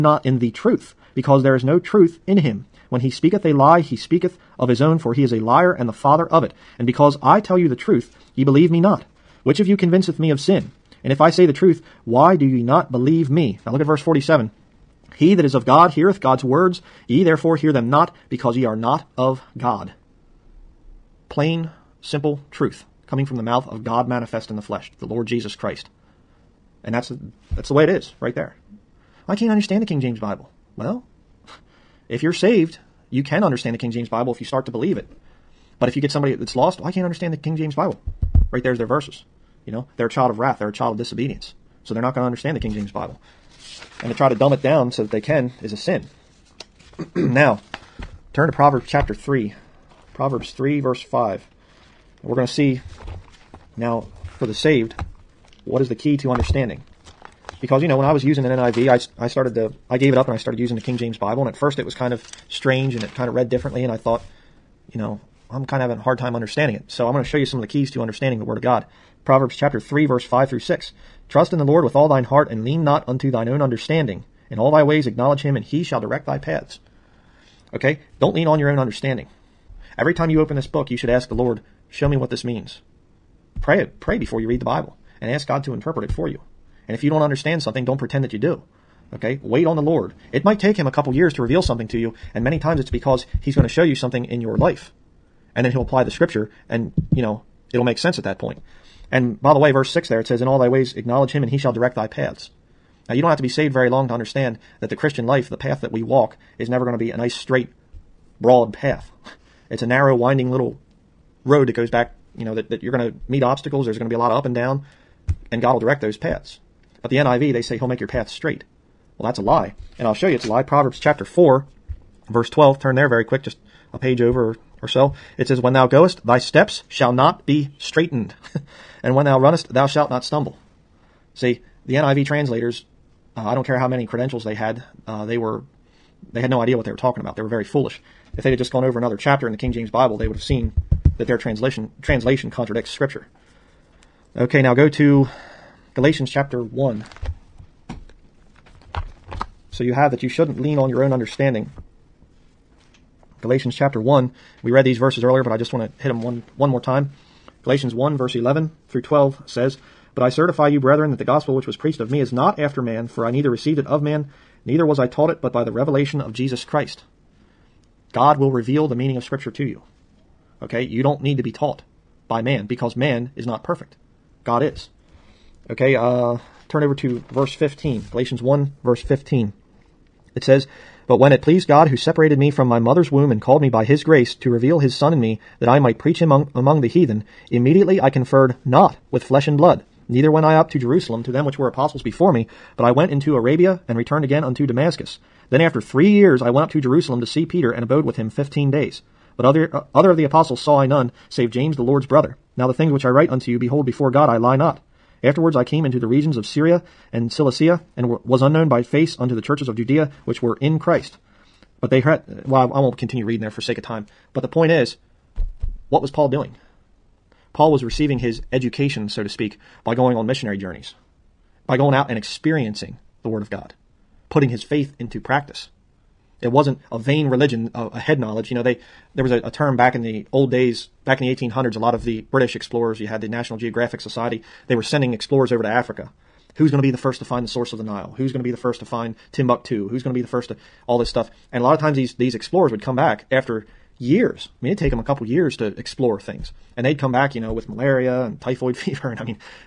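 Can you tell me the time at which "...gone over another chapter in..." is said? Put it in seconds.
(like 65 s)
138 s.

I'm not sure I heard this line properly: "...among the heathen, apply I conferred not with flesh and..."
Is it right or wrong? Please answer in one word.
wrong.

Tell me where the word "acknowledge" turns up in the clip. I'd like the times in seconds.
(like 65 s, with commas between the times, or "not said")
75 s, 100 s.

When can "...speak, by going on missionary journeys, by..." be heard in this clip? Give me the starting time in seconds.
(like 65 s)
219 s.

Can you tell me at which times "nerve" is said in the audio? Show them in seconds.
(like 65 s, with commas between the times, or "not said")
not said.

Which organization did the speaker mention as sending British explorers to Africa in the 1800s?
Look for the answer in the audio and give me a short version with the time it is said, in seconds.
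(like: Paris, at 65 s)
National Geographic Society, at 233 s.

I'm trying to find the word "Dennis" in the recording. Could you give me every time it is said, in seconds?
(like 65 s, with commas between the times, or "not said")
not said.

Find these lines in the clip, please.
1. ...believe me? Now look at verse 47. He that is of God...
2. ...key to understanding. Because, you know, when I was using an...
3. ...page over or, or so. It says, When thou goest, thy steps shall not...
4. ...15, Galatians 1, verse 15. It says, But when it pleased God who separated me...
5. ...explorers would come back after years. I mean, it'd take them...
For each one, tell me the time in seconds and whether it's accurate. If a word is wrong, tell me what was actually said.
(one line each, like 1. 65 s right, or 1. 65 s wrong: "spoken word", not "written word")
1. 12 s right
2. 55 s right
3. 123 s right
4. 177 s right
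5. 242 s right.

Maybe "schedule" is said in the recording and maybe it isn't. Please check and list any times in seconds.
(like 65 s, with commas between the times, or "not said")
not said.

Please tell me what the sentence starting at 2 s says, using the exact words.
When he speaketh a lie, he speaketh of his own, for he is a liar and the father of it.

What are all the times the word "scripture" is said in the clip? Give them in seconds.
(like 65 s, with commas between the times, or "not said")
96 s, 142 s, 169 s.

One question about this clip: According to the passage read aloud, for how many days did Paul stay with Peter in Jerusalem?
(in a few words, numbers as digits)
15.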